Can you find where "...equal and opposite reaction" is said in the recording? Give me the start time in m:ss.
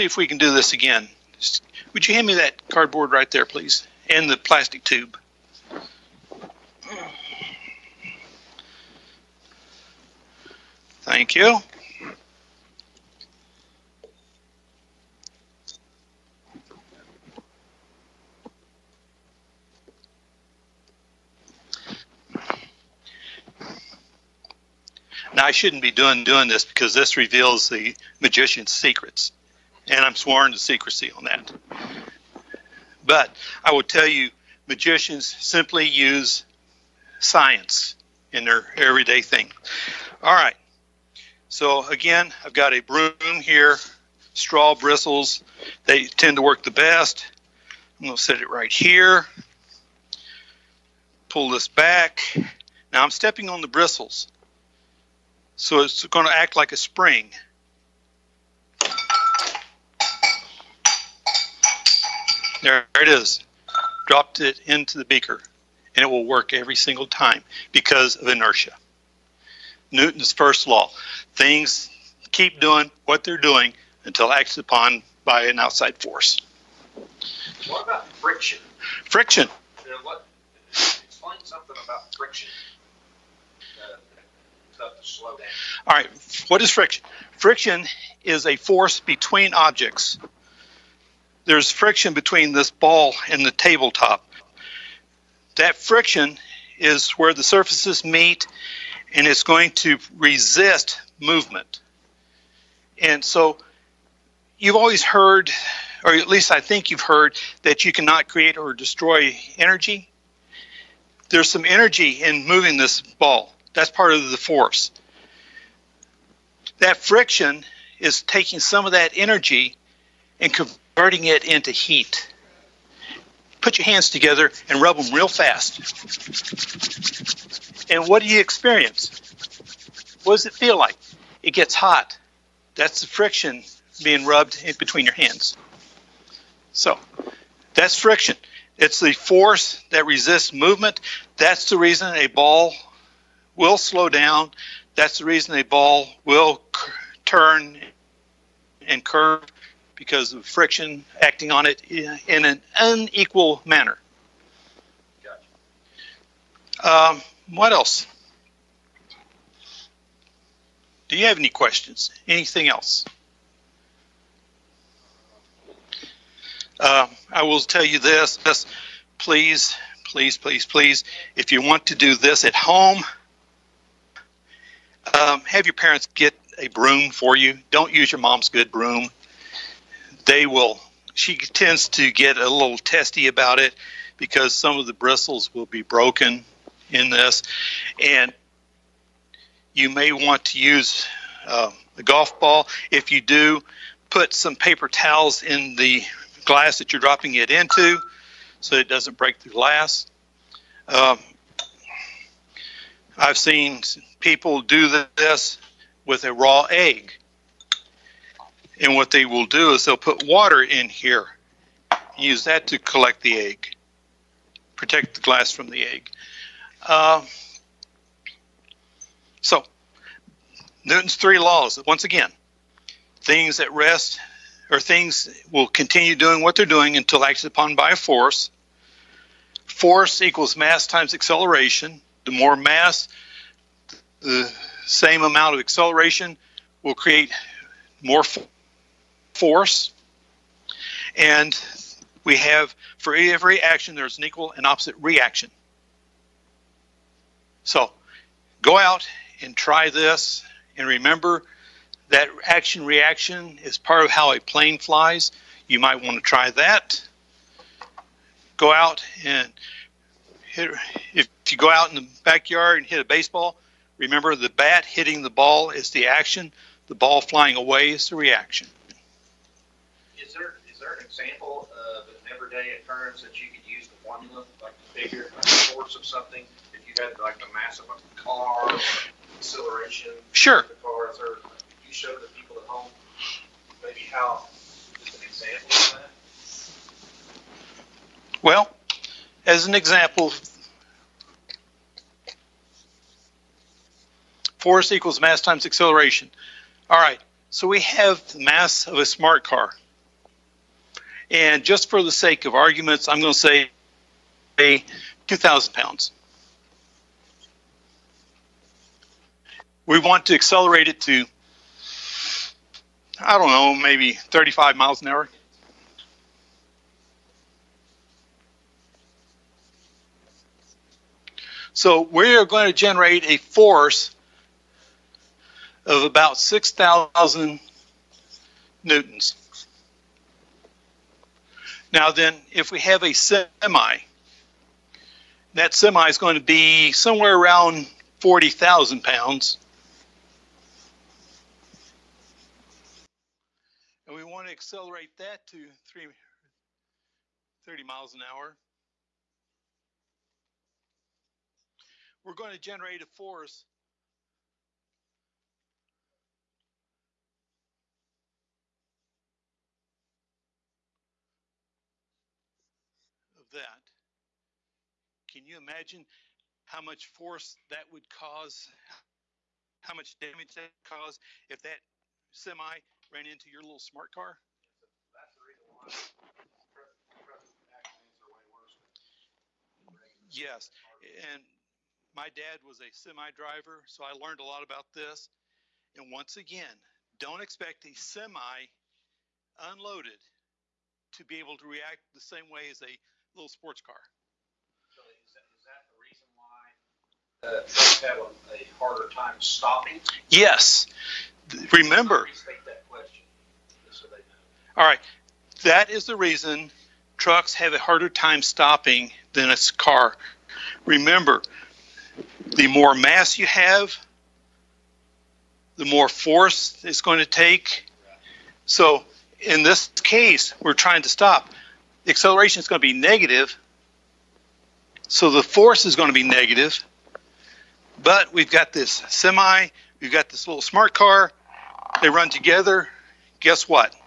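4:04.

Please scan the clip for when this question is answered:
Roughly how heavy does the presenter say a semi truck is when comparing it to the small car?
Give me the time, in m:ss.
5:38.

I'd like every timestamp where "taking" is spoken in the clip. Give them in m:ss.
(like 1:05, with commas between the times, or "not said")
1:58.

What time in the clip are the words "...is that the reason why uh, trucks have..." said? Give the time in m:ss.
6:35.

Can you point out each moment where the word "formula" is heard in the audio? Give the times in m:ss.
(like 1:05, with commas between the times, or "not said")
4:33.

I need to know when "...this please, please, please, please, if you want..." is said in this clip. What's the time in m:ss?
2:48.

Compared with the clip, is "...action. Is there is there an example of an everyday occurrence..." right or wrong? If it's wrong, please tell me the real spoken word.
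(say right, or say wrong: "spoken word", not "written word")
wrong: "reaction", not "action".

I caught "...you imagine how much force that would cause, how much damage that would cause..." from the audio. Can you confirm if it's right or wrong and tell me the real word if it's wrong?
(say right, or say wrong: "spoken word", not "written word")
right.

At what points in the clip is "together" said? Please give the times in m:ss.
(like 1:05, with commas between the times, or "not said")
2:04, 7:12.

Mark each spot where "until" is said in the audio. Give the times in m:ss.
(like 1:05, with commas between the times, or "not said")
1:14, 3:46.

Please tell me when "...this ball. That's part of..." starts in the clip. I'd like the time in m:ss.
1:52.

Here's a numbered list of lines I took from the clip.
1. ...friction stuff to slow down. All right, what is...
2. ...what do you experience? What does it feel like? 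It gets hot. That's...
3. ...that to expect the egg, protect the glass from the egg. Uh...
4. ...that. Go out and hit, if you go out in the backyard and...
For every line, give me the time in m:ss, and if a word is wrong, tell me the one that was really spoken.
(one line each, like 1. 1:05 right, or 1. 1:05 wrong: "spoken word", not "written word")
1. 1:22 right
2. 2:08 right
3. 3:32 wrong: "collect", not "expect"
4. 4:16 right.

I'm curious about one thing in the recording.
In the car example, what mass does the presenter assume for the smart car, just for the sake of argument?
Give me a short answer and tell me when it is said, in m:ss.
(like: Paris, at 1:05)
2,000 pounds, at 5:05.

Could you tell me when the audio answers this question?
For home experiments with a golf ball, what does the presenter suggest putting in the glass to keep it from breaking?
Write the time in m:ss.
3:14.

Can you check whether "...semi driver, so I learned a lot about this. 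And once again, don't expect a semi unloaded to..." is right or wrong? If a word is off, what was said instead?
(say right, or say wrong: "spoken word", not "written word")
right.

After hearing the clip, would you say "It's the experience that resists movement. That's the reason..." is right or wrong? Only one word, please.
wrong.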